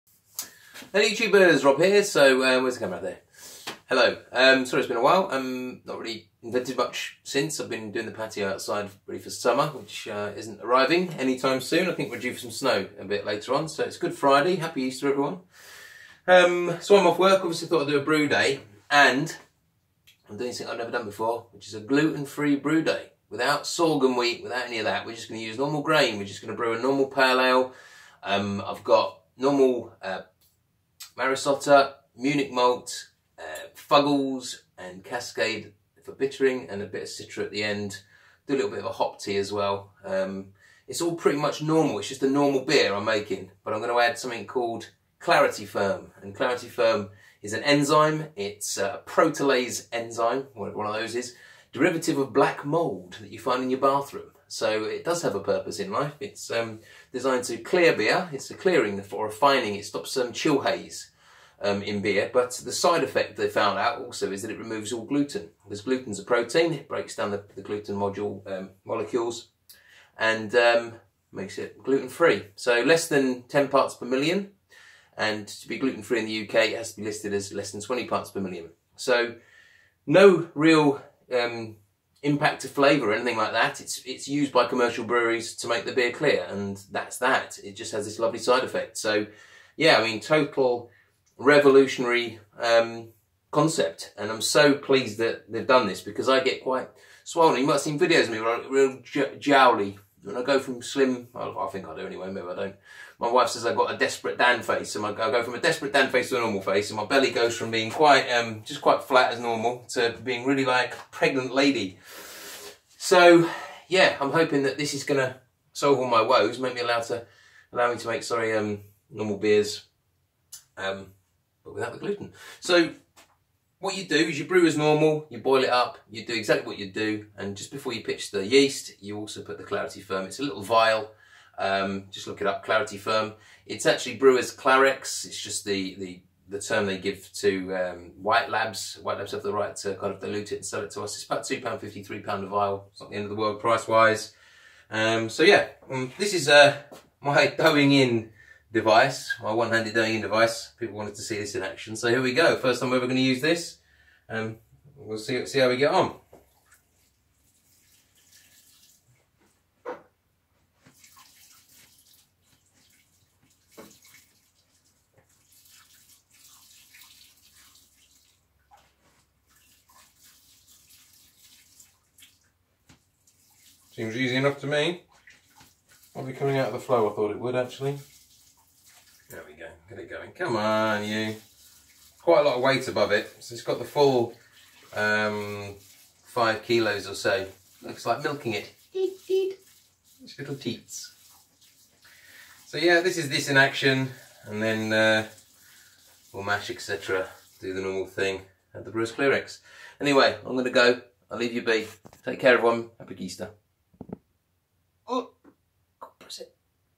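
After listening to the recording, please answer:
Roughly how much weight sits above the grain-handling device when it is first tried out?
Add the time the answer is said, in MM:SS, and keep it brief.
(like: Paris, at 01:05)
5 kilos, at 03:06.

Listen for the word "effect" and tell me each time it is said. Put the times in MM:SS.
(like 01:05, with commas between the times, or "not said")
01:03, 01:28.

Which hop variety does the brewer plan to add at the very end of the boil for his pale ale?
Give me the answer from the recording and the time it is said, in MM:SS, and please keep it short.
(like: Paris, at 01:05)
Citra, at 00:37.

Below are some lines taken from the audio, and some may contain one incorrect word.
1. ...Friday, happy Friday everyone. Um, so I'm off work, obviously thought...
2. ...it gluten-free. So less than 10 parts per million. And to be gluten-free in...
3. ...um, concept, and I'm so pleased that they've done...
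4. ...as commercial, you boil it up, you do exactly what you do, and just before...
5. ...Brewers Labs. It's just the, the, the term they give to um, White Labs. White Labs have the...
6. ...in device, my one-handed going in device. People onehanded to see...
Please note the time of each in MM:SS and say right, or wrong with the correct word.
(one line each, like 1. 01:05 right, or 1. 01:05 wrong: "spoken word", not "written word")
1. 00:14 wrong: "Easter", not "Friday"
2. 01:11 right
3. 01:32 right
4. 02:04 wrong: "normal", not "commercial"
5. 02:14 wrong: "Clarex", not "Labs"
6. 02:27 wrong: "wanted", not "onehanded".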